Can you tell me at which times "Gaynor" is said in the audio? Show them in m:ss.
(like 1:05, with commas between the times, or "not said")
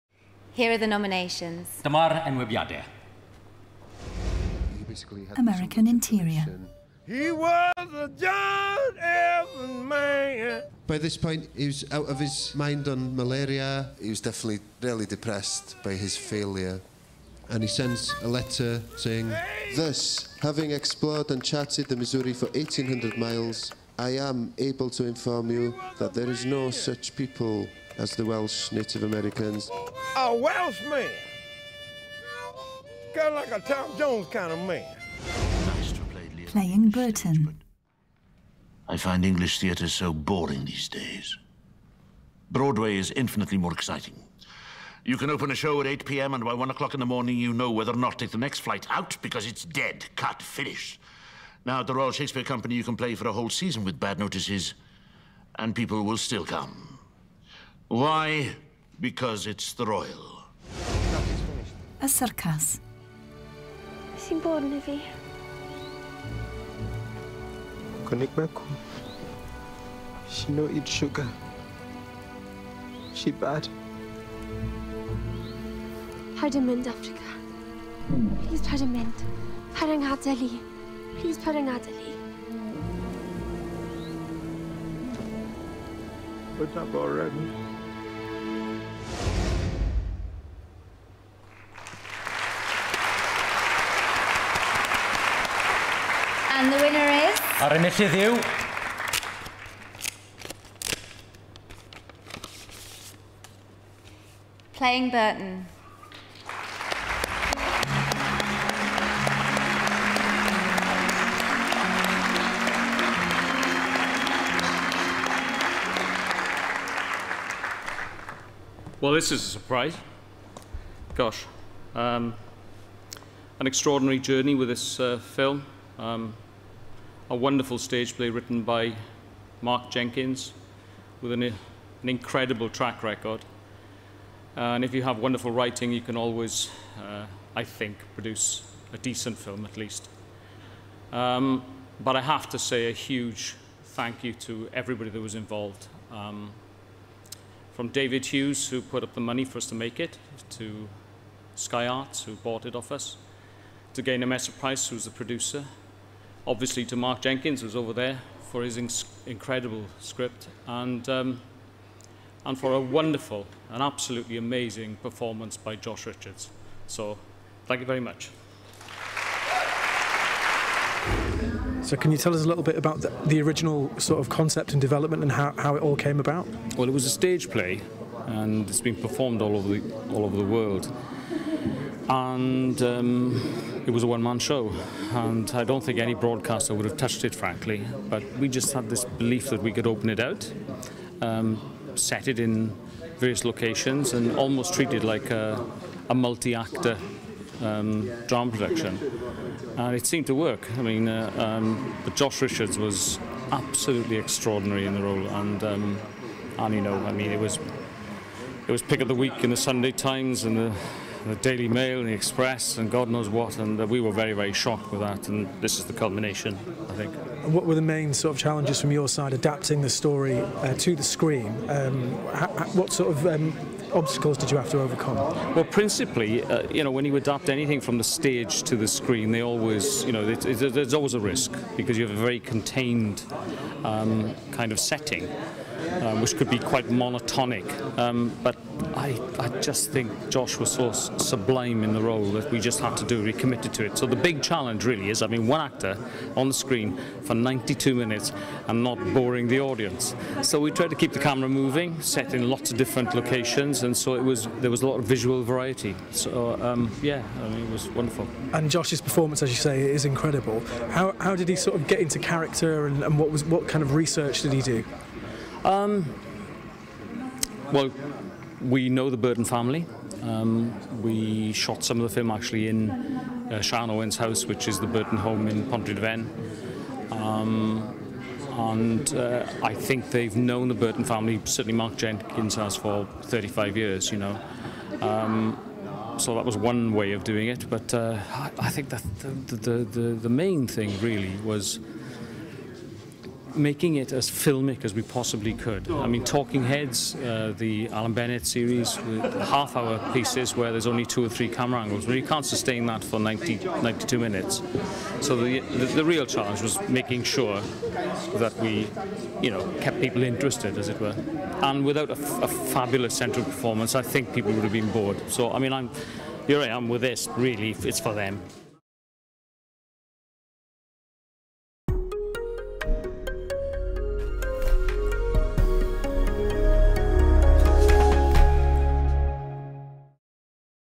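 2:34.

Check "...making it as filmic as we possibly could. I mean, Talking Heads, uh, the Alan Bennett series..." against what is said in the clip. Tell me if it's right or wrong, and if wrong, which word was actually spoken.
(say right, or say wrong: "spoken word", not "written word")
right.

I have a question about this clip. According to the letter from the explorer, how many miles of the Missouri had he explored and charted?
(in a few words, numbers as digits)
1,800.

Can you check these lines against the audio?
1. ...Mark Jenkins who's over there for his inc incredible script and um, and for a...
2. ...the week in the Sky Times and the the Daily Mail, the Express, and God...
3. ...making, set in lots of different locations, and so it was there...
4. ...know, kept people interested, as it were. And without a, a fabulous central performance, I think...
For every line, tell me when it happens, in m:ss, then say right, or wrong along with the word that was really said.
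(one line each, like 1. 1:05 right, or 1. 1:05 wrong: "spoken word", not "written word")
1. 2:36 right
2. 3:29 wrong: "Sunday", not "Sky"
3. 4:11 wrong: "moving", not "making"
4. 5:09 right.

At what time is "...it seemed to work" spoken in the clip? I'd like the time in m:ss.
3:19.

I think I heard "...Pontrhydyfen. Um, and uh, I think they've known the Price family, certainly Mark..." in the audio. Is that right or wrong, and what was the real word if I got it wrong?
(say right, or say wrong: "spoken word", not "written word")
wrong: "Burton", not "Price".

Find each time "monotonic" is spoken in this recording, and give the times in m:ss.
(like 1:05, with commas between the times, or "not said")
3:56.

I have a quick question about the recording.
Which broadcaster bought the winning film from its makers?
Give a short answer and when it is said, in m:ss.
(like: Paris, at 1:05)
Sky Arts, at 2:31.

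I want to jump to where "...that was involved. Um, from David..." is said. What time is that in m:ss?
2:25.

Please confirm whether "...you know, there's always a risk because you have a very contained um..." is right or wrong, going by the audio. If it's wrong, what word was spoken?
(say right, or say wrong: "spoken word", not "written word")
right.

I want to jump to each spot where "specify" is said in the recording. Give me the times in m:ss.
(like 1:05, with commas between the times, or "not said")
not said.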